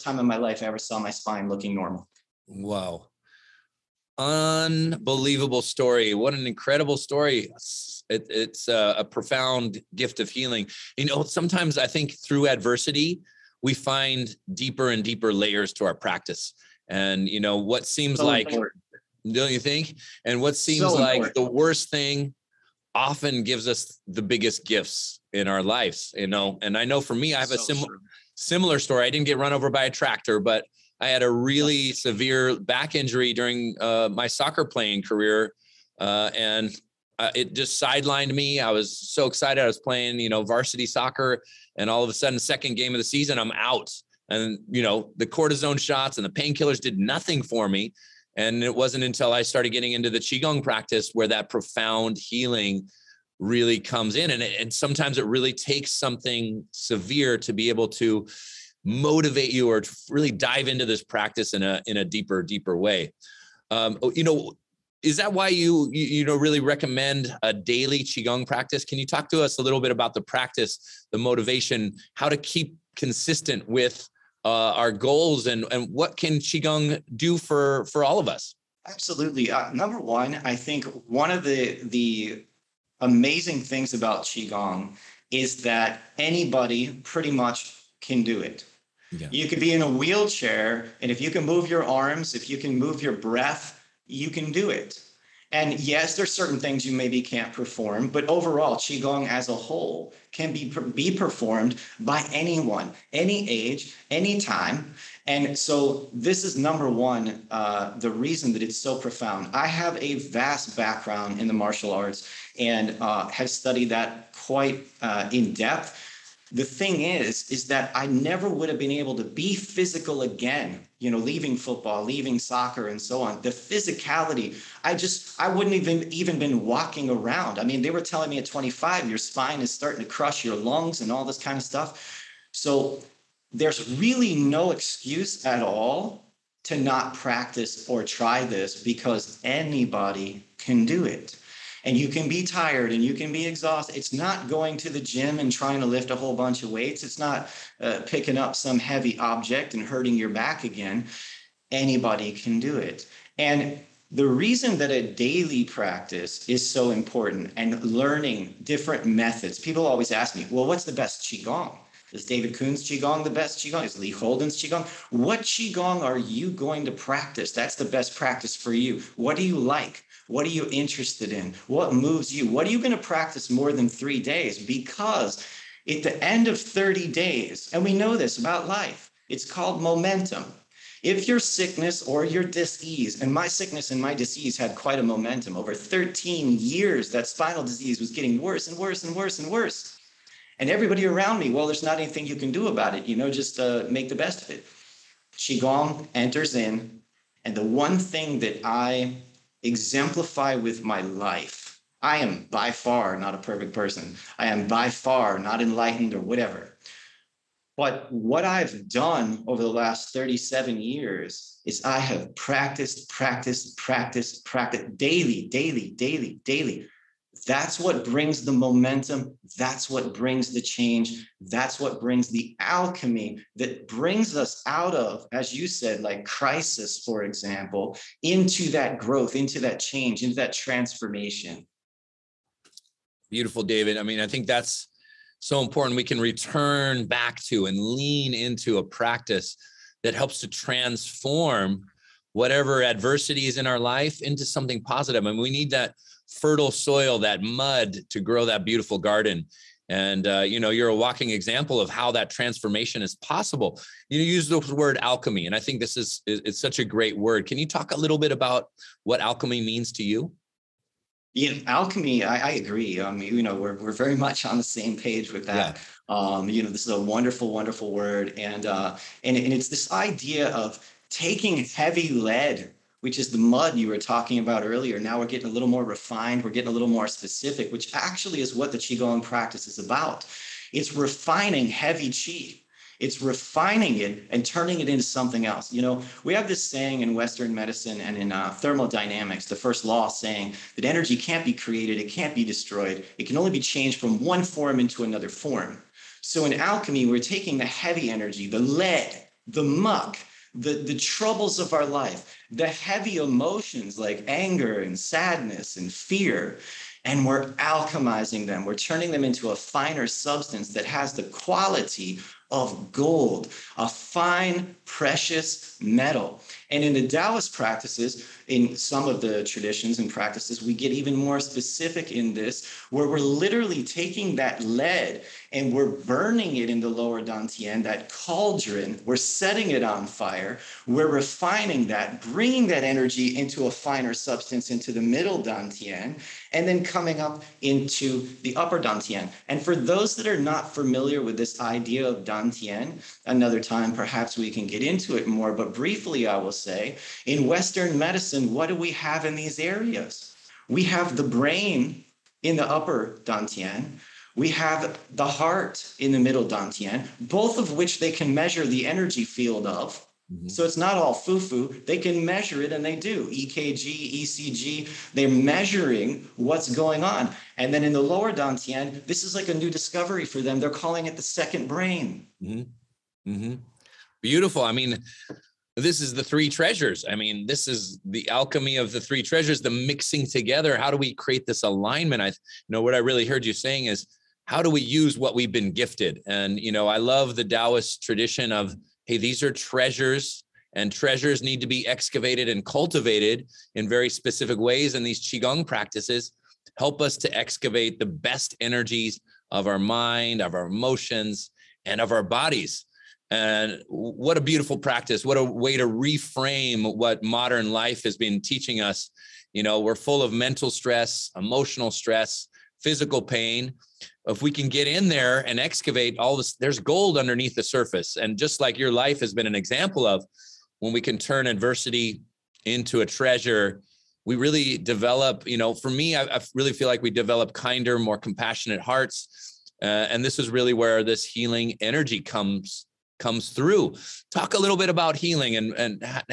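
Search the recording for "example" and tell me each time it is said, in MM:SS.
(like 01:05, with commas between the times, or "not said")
03:47, 04:11, 06:59.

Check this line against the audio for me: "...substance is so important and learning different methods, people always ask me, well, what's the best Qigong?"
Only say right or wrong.
wrong.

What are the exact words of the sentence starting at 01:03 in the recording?
Um, oh, you know, is that why you, you, you know, really recommend a daily Qigong practice?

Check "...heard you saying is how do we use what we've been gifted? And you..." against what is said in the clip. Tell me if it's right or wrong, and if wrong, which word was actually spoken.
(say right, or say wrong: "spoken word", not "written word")
right.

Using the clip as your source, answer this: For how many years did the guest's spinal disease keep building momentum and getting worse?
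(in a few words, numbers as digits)
13.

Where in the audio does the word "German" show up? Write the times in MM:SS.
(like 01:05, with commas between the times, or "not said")
not said.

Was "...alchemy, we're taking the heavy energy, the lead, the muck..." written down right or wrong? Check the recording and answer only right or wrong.
right.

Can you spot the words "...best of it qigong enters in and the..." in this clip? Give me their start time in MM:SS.
03:14.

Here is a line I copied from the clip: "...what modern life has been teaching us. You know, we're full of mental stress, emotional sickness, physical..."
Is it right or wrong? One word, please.
wrong.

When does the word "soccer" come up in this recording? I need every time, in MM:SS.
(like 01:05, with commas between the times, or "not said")
00:34, 00:40, 02:02.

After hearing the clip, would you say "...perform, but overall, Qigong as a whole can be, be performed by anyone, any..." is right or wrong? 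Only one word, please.
right.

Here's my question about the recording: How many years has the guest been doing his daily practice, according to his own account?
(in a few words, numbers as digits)
37.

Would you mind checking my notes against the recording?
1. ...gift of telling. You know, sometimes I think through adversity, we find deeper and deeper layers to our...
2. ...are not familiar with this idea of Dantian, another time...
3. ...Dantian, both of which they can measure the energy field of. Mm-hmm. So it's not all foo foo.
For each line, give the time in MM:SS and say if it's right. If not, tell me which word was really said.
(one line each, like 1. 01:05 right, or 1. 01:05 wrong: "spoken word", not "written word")
1. 00:09 wrong: "healing", not "telling"
2. 05:40 right
3. 05:56 right.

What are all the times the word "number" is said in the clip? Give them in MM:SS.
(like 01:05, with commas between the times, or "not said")
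01:19, 01:46.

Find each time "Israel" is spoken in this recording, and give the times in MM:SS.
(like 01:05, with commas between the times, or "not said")
not said.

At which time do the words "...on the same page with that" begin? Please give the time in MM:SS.
04:24.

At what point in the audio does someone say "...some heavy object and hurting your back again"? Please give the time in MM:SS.
02:28.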